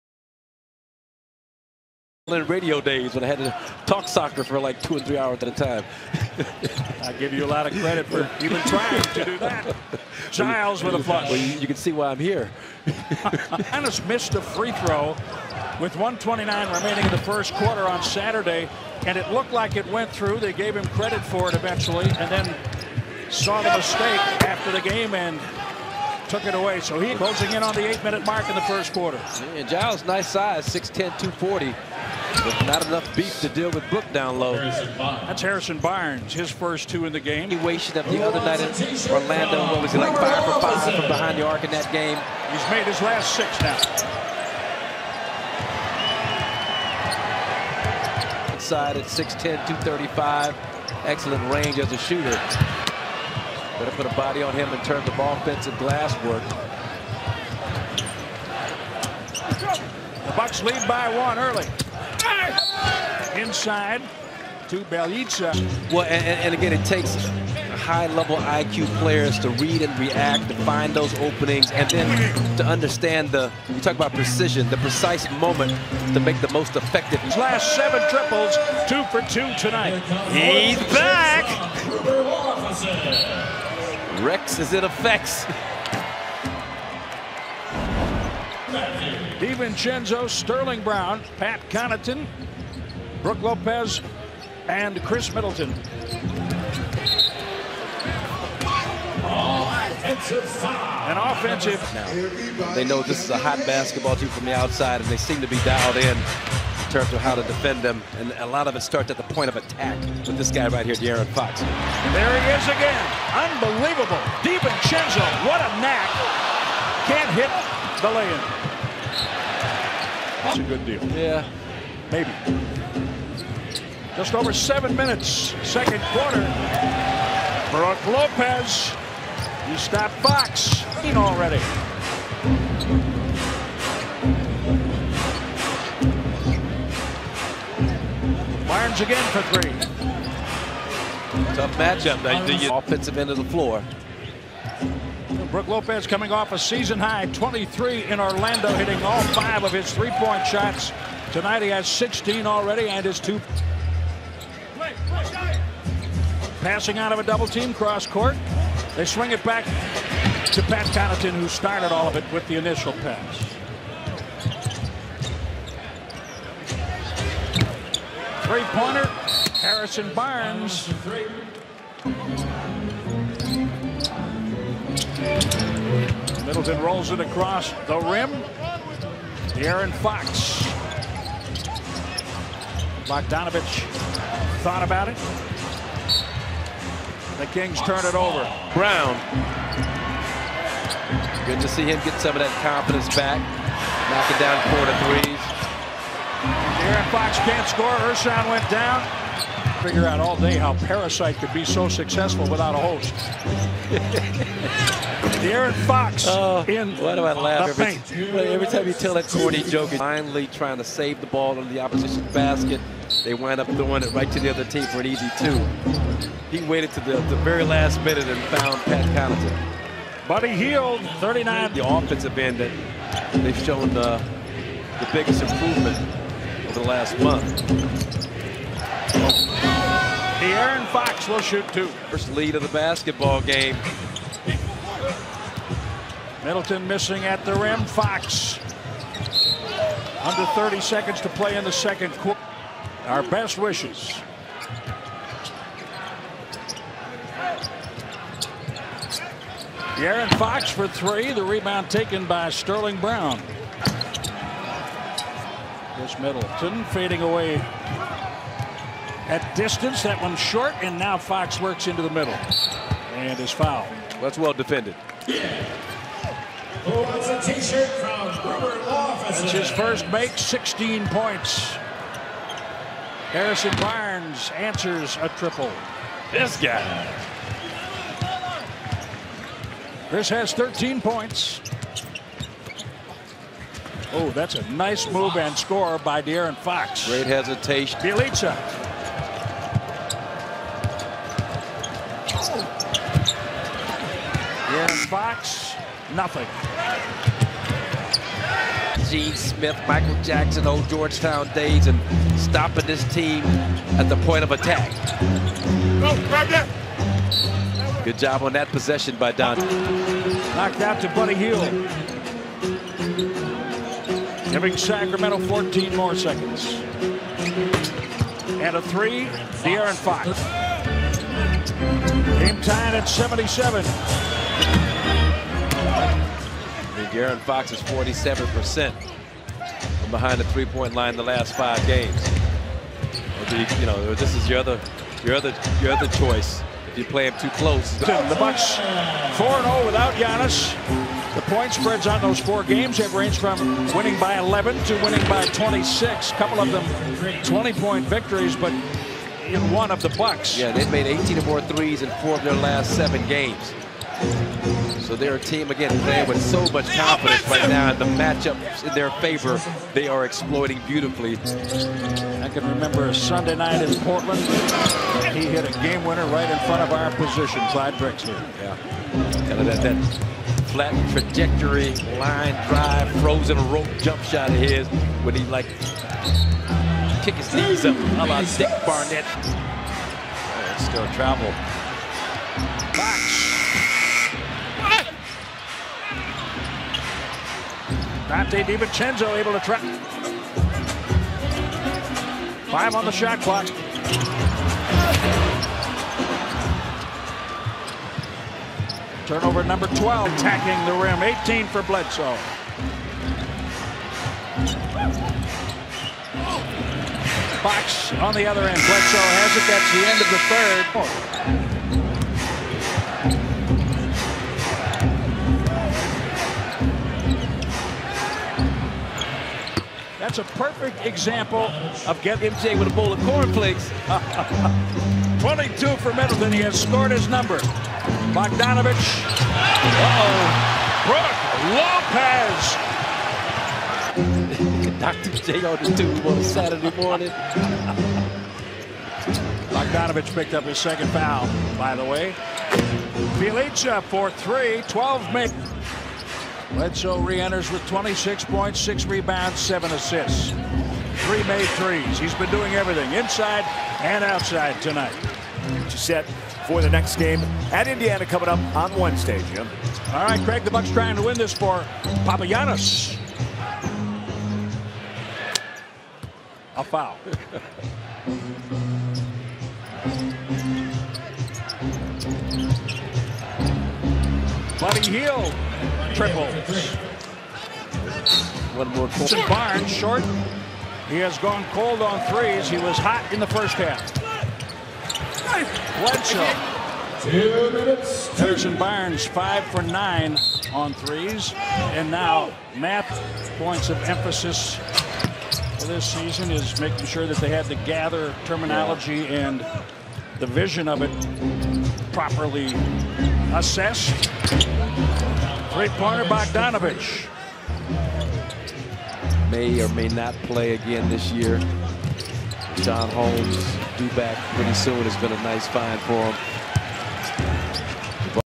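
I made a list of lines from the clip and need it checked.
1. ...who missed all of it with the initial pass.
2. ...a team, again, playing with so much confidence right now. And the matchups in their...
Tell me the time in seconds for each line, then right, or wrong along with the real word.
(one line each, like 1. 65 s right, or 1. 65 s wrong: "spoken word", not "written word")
1. 161 s wrong: "started", not "missed"
2. 355 s right.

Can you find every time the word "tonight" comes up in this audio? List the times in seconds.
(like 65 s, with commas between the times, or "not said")
79 s, 151 s, 454 s.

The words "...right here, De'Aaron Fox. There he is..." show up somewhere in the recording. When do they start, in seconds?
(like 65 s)
110 s.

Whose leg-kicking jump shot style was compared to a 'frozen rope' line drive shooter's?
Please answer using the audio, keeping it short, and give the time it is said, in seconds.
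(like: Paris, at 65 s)
Dick Barnett, at 378 s.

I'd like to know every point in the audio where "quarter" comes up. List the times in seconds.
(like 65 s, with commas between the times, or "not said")
17 s, 28 s, 126 s, 242 s.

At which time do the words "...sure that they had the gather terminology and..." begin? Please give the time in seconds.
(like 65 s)
497 s.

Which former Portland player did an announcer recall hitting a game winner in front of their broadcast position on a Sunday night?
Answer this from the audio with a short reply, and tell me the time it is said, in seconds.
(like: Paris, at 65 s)
Clyde Drexler, at 367 s.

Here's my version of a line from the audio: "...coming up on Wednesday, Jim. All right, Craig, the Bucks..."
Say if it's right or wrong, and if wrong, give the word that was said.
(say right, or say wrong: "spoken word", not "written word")
right.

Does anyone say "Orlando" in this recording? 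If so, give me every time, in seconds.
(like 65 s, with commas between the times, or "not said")
39 s, 148 s.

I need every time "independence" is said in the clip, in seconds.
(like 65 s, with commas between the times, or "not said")
not said.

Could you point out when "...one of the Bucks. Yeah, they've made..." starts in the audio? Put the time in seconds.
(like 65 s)
349 s.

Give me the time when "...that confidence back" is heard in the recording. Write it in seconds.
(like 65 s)
192 s.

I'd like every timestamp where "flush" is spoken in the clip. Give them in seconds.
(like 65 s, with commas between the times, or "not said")
11 s.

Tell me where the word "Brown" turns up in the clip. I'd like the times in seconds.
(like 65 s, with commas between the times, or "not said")
90 s, 188 s, 252 s.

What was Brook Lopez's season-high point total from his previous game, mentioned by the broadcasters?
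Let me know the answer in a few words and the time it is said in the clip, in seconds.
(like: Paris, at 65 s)
23, at 147 s.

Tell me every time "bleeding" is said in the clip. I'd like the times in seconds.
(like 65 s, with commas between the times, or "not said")
not said.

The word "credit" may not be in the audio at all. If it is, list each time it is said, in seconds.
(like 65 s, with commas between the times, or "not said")
7 s, 20 s.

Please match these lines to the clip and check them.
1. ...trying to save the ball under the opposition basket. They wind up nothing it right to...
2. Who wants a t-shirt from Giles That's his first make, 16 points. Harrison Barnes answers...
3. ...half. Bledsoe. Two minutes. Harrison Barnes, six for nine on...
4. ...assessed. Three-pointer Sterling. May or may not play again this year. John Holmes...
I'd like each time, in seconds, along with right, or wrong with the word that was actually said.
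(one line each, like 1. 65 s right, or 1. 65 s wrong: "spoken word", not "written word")
1. 210 s wrong: "throwing", not "nothing"
2. 266 s wrong: "Law", not "Giles"
3. 483 s wrong: "five", not "six"
4. 503 s wrong: "Bogdanovic", not "Sterling".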